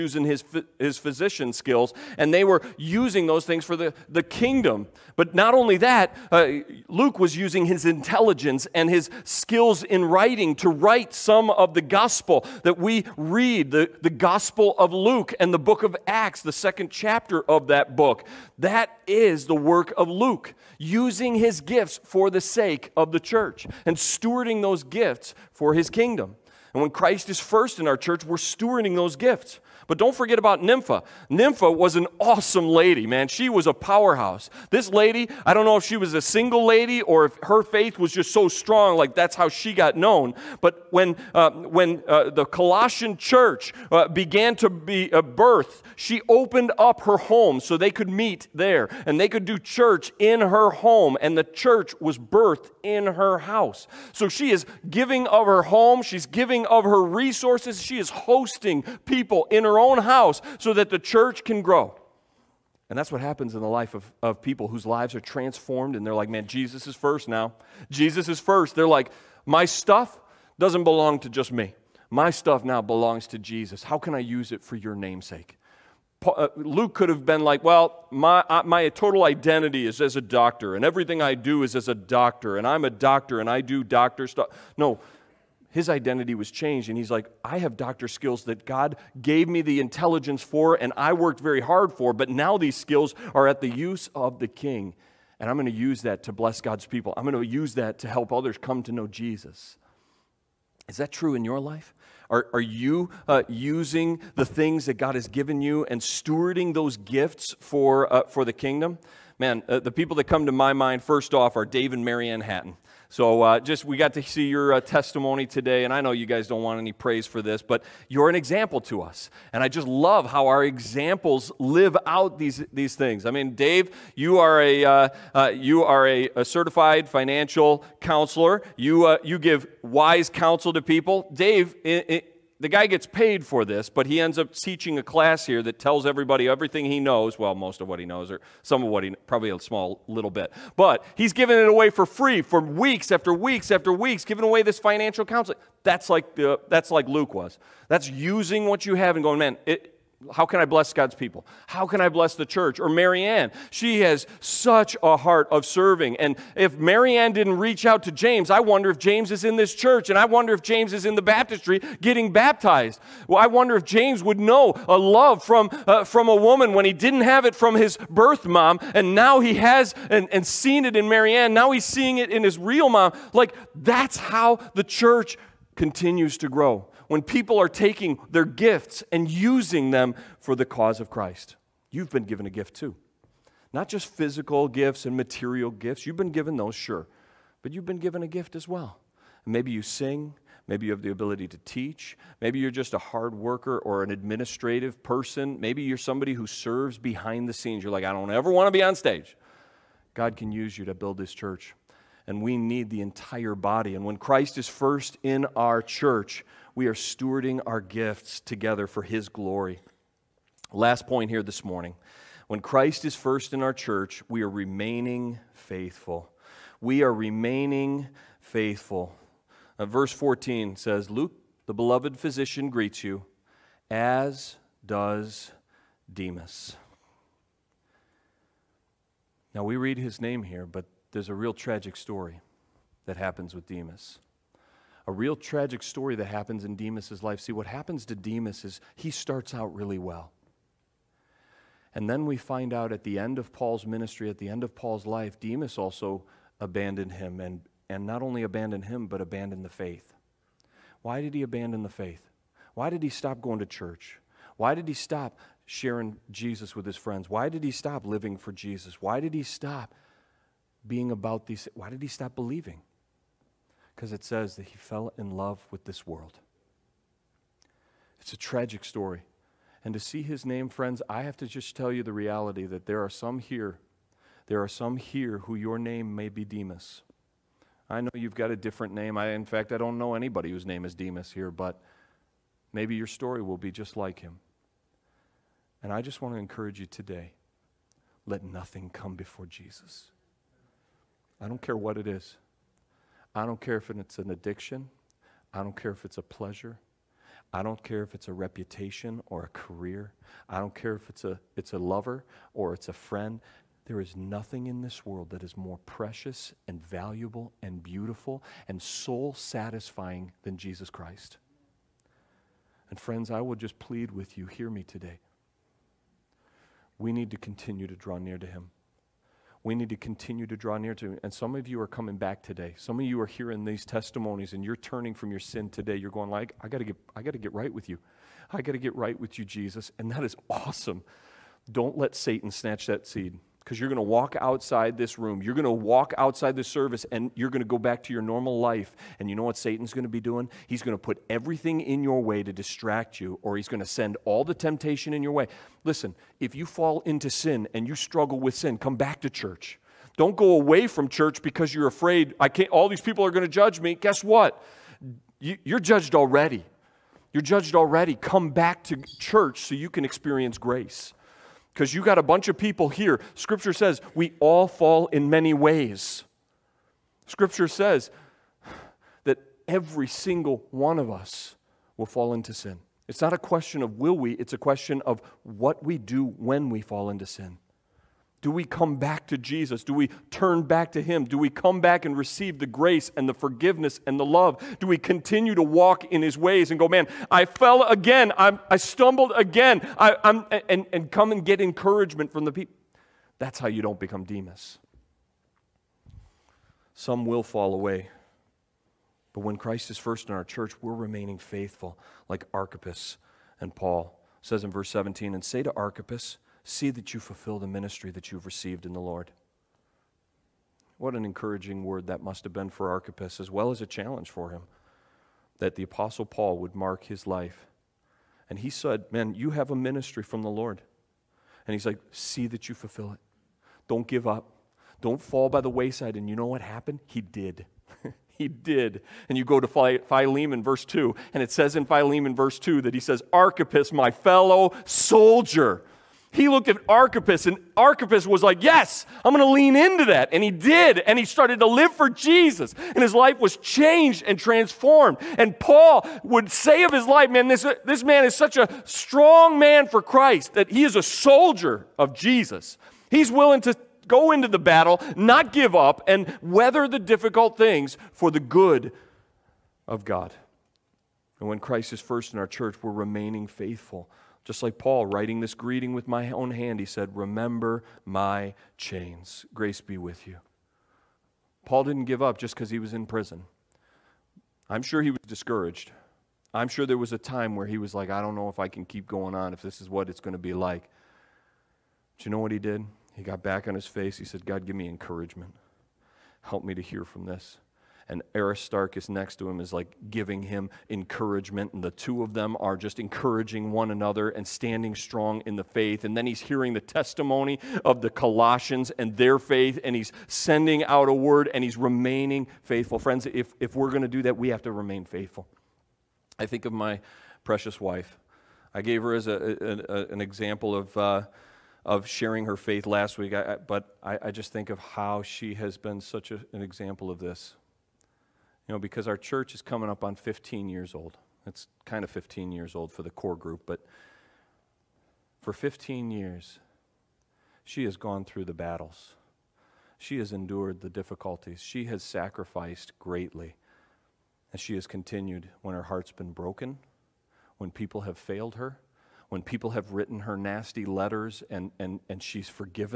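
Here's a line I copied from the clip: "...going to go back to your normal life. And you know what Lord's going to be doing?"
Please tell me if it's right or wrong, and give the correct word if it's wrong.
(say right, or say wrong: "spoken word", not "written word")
wrong: "Satan", not "Lord".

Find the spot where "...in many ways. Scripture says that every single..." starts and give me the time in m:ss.
6:05.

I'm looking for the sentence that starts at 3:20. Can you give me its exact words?
God can use you to build this church.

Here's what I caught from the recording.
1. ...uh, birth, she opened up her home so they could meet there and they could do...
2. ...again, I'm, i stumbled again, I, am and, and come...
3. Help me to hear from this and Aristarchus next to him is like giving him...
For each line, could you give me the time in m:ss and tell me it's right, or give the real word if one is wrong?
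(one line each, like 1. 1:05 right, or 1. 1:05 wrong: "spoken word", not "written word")
1. 0:45 right
2. 6:27 right
3. 8:06 right.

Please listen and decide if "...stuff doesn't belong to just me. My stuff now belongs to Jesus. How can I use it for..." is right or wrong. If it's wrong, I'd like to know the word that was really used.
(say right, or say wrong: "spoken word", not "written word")
right.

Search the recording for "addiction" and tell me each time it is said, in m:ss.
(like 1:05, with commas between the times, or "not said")
4:54.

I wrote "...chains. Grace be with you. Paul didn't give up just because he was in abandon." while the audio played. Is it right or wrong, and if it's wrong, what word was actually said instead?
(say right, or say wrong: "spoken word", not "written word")
wrong: "prison", not "abandon".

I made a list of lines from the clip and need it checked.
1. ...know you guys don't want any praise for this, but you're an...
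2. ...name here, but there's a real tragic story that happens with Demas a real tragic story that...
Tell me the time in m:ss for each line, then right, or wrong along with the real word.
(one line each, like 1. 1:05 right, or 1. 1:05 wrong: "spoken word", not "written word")
1. 1:56 right
2. 3:50 right.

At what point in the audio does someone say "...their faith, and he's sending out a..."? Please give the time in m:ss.
8:19.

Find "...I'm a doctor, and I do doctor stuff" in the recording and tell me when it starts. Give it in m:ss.
1:22.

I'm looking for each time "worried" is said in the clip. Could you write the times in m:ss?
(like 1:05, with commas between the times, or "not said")
not said.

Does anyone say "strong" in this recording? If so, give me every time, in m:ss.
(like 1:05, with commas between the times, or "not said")
0:38, 7:28, 8:14.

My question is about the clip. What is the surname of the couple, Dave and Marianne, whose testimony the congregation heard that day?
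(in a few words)
Hatton.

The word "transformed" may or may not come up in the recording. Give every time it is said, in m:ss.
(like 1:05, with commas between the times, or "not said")
1:05, 7:24.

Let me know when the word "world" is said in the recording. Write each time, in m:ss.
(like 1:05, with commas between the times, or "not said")
4:26, 5:05.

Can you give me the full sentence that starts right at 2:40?
And I wonder if James is in the baptistry getting baptized.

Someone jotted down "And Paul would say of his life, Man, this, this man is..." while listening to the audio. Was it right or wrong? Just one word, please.
right.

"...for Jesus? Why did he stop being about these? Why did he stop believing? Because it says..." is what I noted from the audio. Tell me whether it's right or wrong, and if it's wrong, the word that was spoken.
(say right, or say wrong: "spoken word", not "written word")
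right.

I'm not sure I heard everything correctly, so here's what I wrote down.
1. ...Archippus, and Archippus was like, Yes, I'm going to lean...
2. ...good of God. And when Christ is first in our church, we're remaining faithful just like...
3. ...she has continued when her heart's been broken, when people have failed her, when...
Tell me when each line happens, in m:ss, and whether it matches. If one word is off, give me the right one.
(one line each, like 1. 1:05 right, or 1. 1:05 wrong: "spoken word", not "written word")
1. 7:16 right
2. 7:38 right
3. 8:54 right.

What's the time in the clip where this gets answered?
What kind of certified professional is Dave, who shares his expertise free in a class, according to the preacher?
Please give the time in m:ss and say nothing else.
2:06.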